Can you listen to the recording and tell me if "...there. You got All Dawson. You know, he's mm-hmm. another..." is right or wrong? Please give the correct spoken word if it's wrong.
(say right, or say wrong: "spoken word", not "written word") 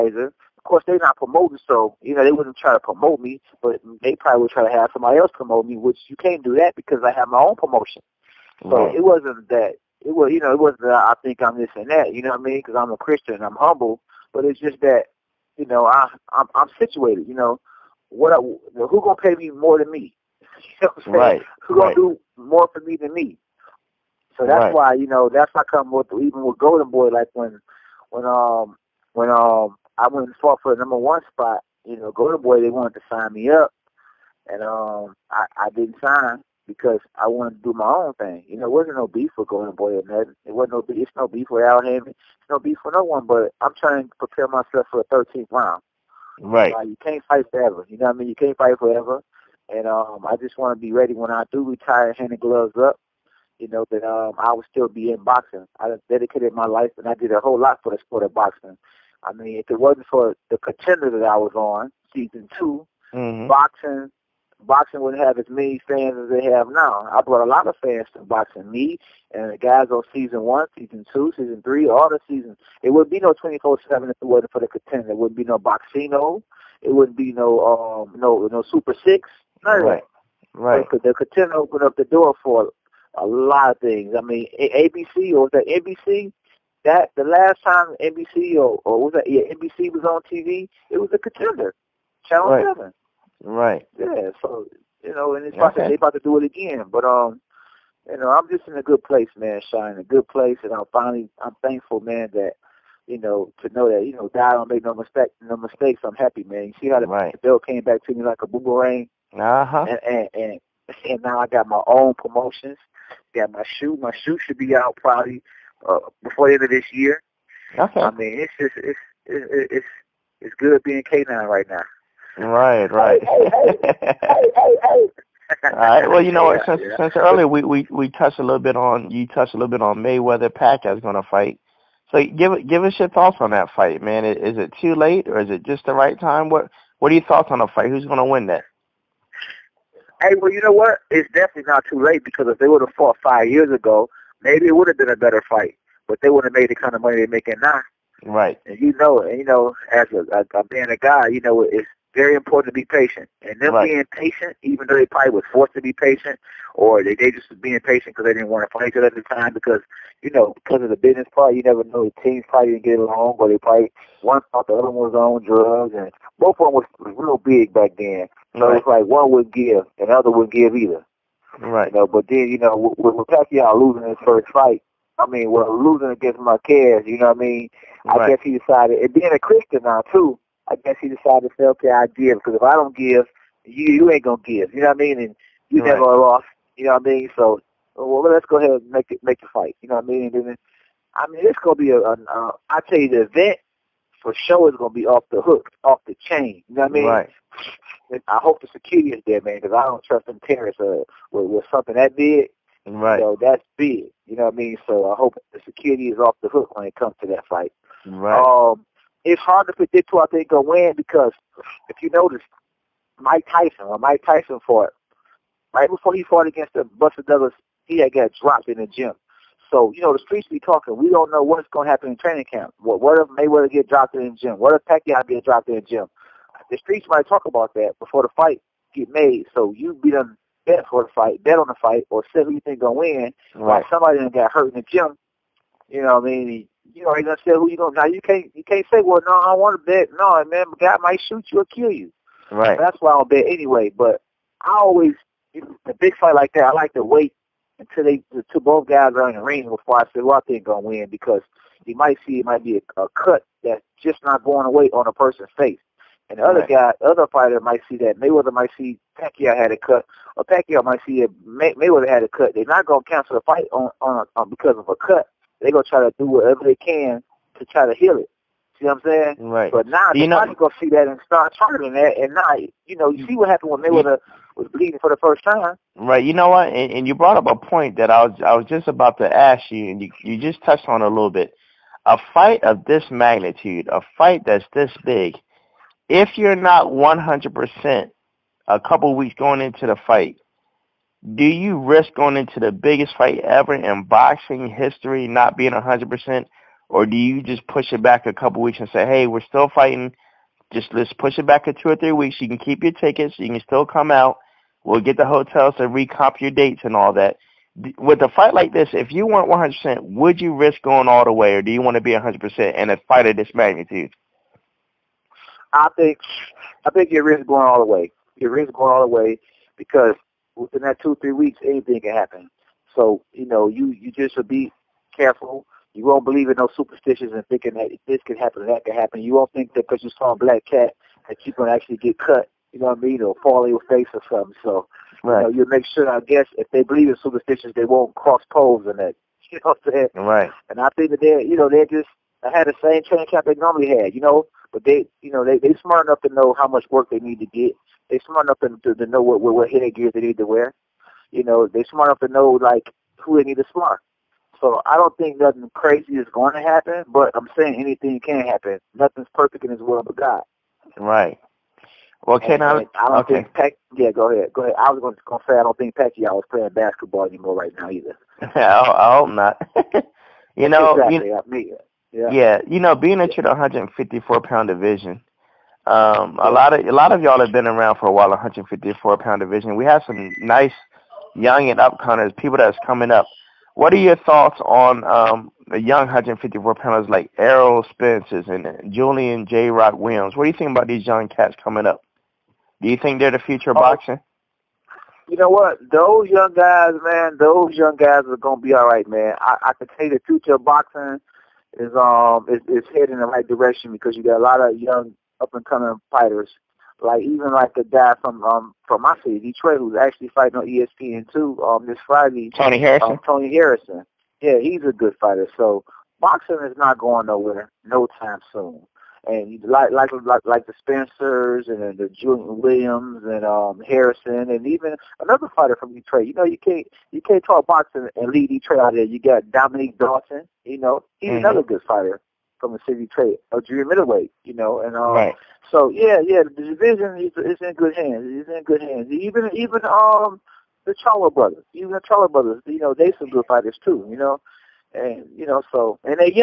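wrong: "Dominique", not "All".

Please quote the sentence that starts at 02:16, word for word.
What what are your thoughts on the fight?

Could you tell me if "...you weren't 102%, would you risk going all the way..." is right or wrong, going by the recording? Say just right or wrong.
wrong.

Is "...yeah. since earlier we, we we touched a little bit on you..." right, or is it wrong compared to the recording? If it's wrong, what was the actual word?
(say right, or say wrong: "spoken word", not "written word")
right.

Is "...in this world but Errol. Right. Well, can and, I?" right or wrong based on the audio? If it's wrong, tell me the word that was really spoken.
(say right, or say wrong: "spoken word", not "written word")
wrong: "God", not "Errol".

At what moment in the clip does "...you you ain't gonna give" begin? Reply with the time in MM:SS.
03:03.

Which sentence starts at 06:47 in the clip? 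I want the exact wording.
Like even like the guy from um from my city, Detroit, who's actually fighting on ESPN two um this Friday.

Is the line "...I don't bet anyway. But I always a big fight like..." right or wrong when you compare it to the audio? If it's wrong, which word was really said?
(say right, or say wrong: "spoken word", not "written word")
right.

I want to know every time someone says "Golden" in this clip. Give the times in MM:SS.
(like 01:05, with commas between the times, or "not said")
00:26, 00:32, 00:39.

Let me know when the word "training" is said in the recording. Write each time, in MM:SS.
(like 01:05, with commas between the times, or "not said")
03:42, 05:43.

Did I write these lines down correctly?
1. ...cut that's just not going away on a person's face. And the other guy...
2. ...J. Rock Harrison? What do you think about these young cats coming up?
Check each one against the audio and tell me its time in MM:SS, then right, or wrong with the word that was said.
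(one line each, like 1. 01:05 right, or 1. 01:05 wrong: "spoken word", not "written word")
1. 04:13 right
2. 06:29 wrong: "Williams", not "Harrison".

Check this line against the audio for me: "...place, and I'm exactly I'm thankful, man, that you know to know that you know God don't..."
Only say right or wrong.
wrong.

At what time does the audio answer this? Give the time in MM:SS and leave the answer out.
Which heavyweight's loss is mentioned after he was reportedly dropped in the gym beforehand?
03:36.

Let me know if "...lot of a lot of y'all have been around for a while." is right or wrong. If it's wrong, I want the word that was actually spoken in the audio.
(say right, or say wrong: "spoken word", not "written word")
right.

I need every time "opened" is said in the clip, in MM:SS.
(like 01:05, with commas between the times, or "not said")
01:21.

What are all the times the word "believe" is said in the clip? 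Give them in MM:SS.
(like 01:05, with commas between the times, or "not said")
05:26, 05:36.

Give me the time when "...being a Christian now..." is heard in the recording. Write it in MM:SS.
02:59.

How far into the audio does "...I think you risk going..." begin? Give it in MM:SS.
05:16.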